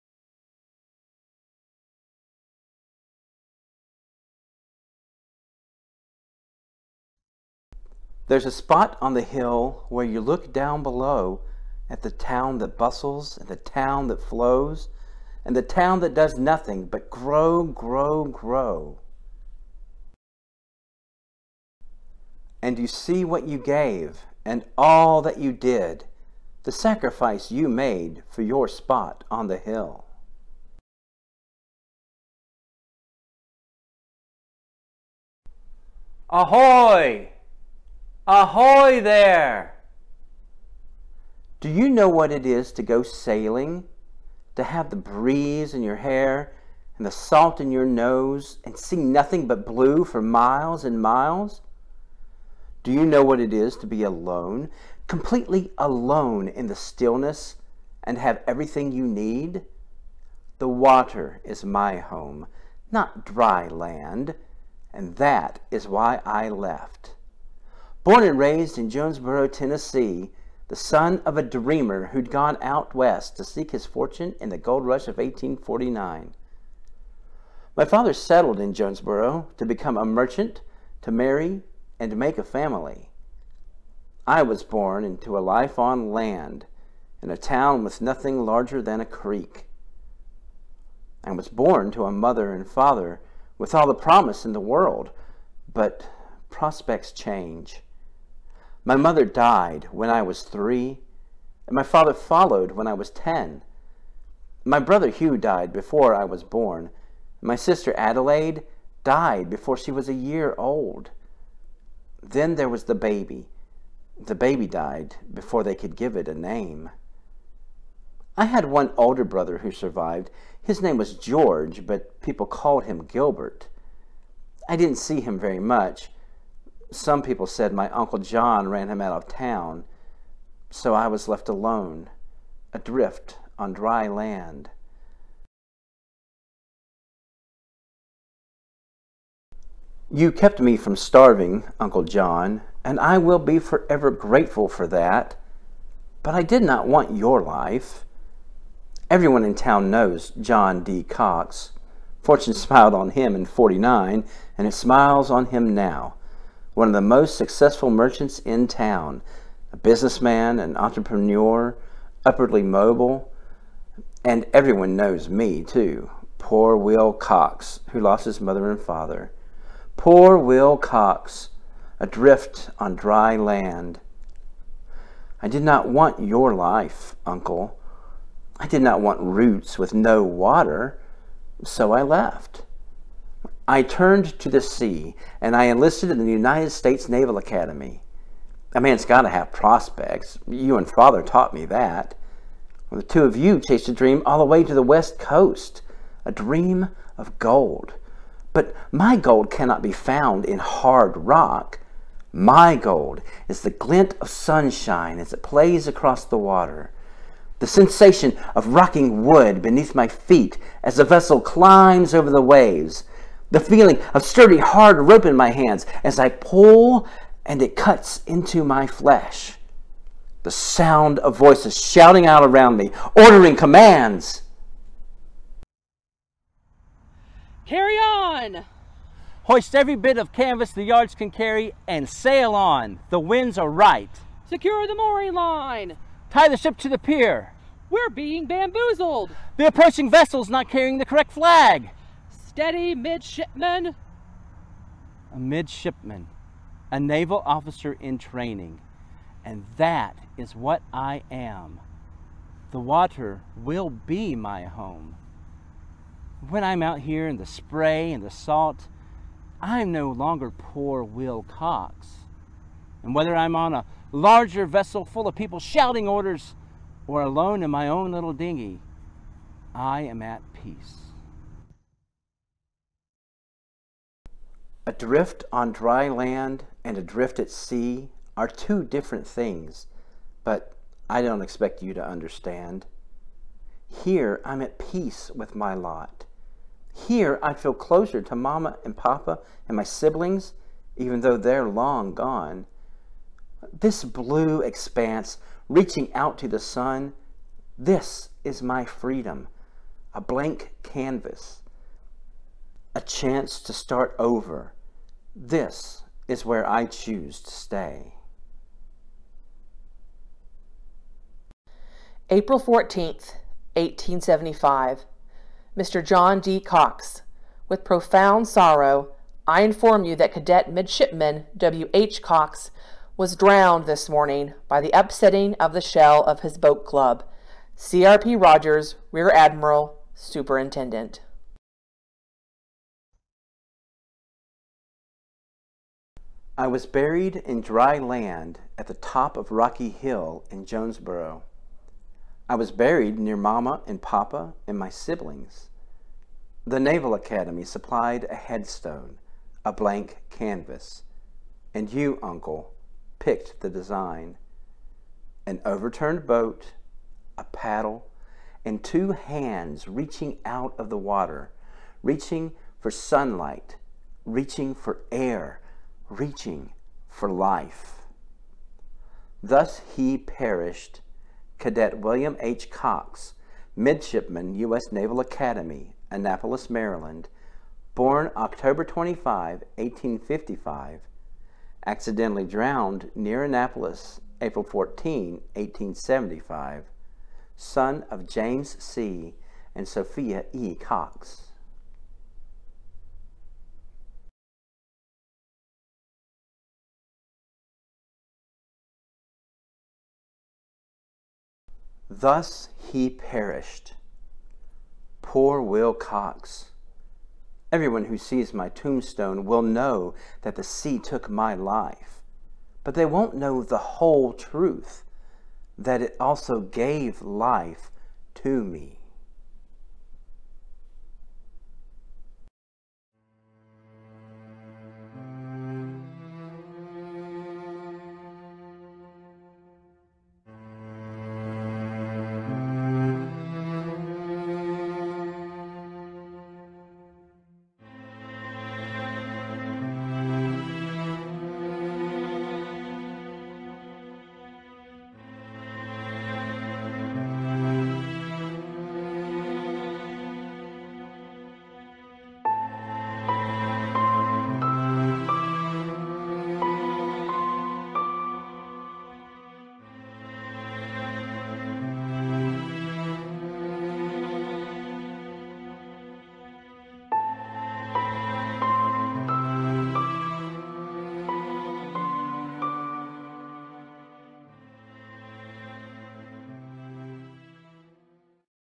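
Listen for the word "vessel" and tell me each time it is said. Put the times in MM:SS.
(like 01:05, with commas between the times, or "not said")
03:31, 04:00, 04:24.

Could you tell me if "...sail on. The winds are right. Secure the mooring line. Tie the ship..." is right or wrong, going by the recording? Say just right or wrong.
right.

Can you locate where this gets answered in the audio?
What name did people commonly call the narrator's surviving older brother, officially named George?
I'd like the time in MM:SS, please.
02:03.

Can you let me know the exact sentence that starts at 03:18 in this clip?
But my gold cannot be found in hard rock.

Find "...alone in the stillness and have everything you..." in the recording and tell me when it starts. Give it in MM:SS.
00:55.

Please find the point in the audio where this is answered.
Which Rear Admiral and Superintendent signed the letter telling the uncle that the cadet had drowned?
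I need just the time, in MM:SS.
05:27.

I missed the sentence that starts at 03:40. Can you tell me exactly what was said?
The sound of voices shouting out around me, ordering commands.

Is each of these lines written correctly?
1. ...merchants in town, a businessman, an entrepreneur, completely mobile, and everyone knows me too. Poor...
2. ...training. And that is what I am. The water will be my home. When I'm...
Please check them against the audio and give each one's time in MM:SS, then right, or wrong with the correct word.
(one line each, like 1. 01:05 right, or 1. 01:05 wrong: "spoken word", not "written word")
1. 02:37 wrong: "upwardly", not "completely"
2. 04:08 right.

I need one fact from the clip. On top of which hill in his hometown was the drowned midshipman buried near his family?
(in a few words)
Rocky Hill.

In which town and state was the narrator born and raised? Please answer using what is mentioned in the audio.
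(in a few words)
Jonesborough, Tennessee.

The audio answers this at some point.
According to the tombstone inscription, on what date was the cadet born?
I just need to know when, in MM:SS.
06:18.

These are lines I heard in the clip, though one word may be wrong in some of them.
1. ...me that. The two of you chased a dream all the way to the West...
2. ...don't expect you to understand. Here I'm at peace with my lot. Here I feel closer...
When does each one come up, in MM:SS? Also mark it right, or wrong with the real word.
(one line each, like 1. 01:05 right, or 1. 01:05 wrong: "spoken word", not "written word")
1. 03:11 right
2. 04:41 right.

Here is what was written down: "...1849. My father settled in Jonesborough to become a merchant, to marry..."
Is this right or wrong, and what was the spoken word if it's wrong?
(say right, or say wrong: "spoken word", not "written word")
right.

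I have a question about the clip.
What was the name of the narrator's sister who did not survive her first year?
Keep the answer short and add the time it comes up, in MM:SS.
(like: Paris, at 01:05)
Adelaide, at 01:47.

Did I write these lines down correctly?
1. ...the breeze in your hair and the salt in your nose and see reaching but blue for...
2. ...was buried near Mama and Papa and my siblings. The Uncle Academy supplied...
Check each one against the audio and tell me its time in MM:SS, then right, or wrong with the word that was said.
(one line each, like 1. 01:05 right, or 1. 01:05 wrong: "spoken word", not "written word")
1. 00:44 wrong: "nothing", not "reaching"
2. 05:42 wrong: "Naval", not "Uncle".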